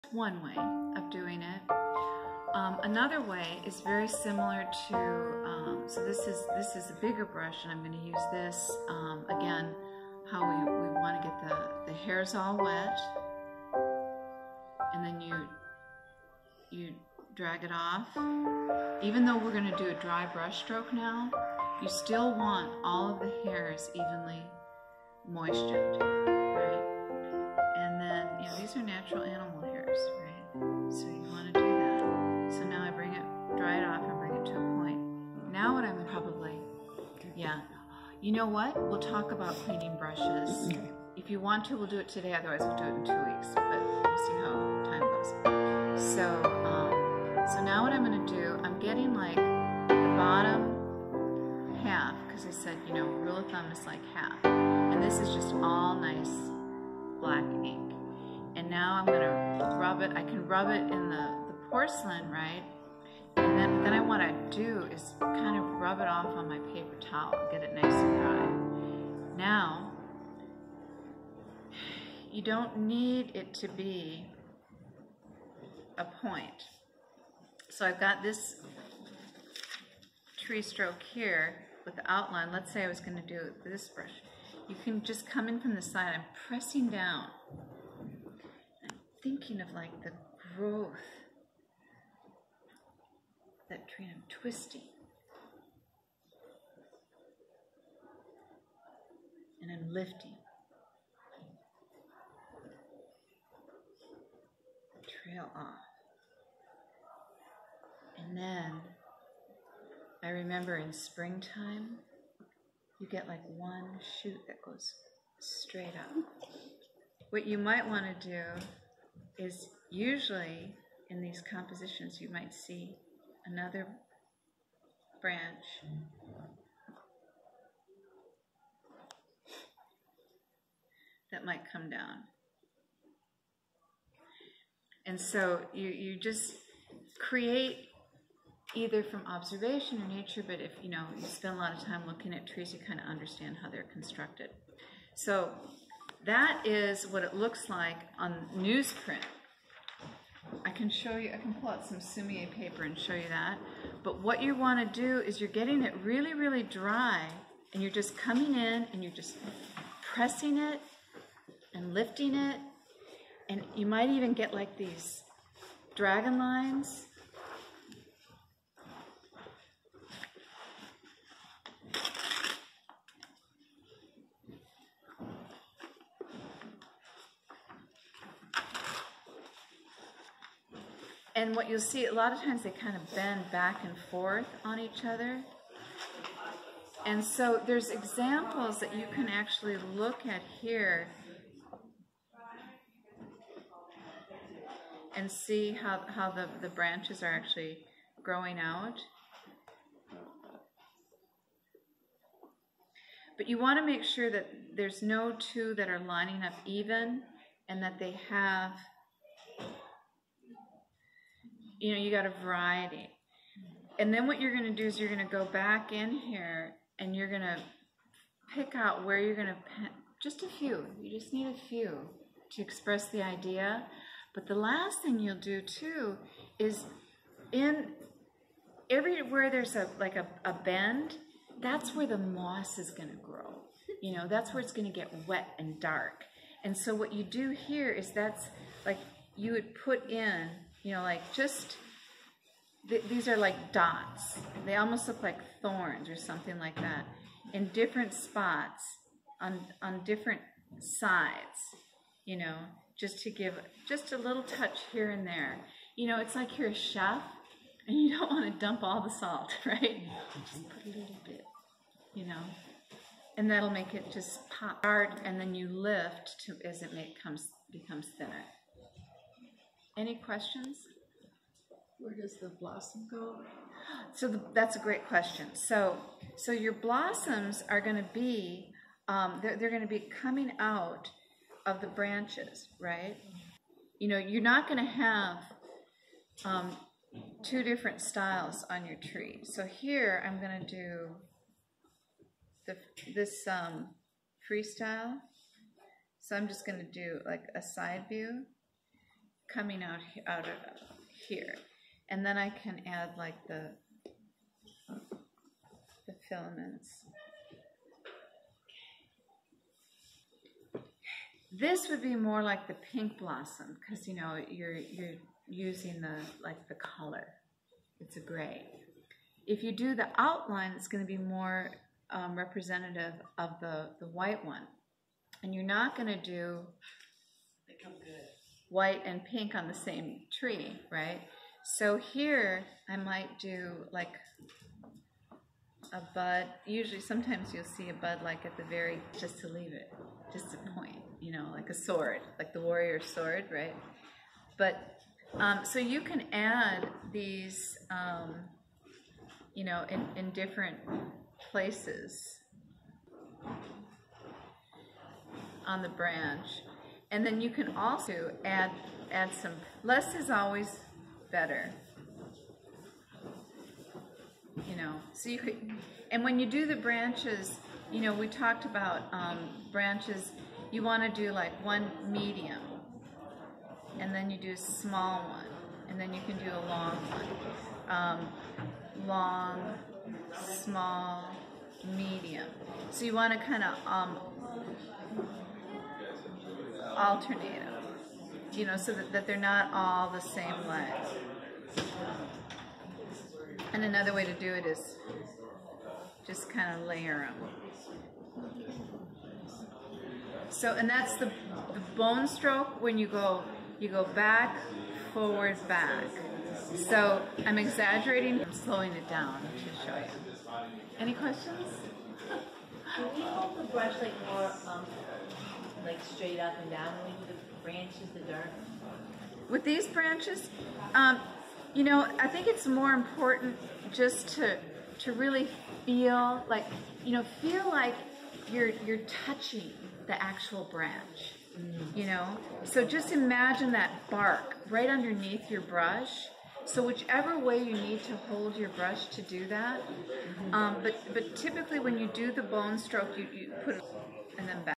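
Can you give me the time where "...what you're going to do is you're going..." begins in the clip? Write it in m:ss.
3:34.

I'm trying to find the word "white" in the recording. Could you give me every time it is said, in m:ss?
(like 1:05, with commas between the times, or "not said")
5:24, 5:28.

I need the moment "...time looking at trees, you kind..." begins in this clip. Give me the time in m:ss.
2:21.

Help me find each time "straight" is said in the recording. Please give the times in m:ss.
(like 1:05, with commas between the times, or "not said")
1:55, 6:56.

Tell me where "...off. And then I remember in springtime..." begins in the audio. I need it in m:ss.
1:45.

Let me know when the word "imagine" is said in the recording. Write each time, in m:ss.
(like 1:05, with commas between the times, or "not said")
7:13.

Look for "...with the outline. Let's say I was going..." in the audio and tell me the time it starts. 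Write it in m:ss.
1:21.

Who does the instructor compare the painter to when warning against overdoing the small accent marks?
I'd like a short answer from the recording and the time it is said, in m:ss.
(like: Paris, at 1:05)
A chef, at 4:16.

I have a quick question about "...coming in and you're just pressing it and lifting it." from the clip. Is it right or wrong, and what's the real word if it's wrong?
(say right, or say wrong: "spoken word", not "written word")
right.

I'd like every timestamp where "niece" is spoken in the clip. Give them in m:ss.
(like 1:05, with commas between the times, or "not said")
not said.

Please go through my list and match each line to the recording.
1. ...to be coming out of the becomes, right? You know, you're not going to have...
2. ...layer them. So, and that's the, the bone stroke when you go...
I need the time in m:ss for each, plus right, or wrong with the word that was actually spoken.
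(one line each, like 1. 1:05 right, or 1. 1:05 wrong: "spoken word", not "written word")
1. 4:39 wrong: "branches", not "becomes"
2. 6:36 right.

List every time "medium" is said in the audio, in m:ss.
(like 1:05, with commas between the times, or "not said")
6:12, 6:21.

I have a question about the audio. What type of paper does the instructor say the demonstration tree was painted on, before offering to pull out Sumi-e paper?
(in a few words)
Newsprint.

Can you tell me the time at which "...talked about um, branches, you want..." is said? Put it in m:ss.
6:08.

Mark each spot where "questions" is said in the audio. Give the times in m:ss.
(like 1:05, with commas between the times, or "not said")
4:30, 4:35, 6:51.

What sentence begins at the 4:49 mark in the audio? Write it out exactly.
So here I'm going to do the, this um, freestyle.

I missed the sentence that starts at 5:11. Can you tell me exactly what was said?
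This would be more like the pink blossom because you know you're you're using the like the color.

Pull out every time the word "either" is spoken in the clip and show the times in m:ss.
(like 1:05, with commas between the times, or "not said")
2:18.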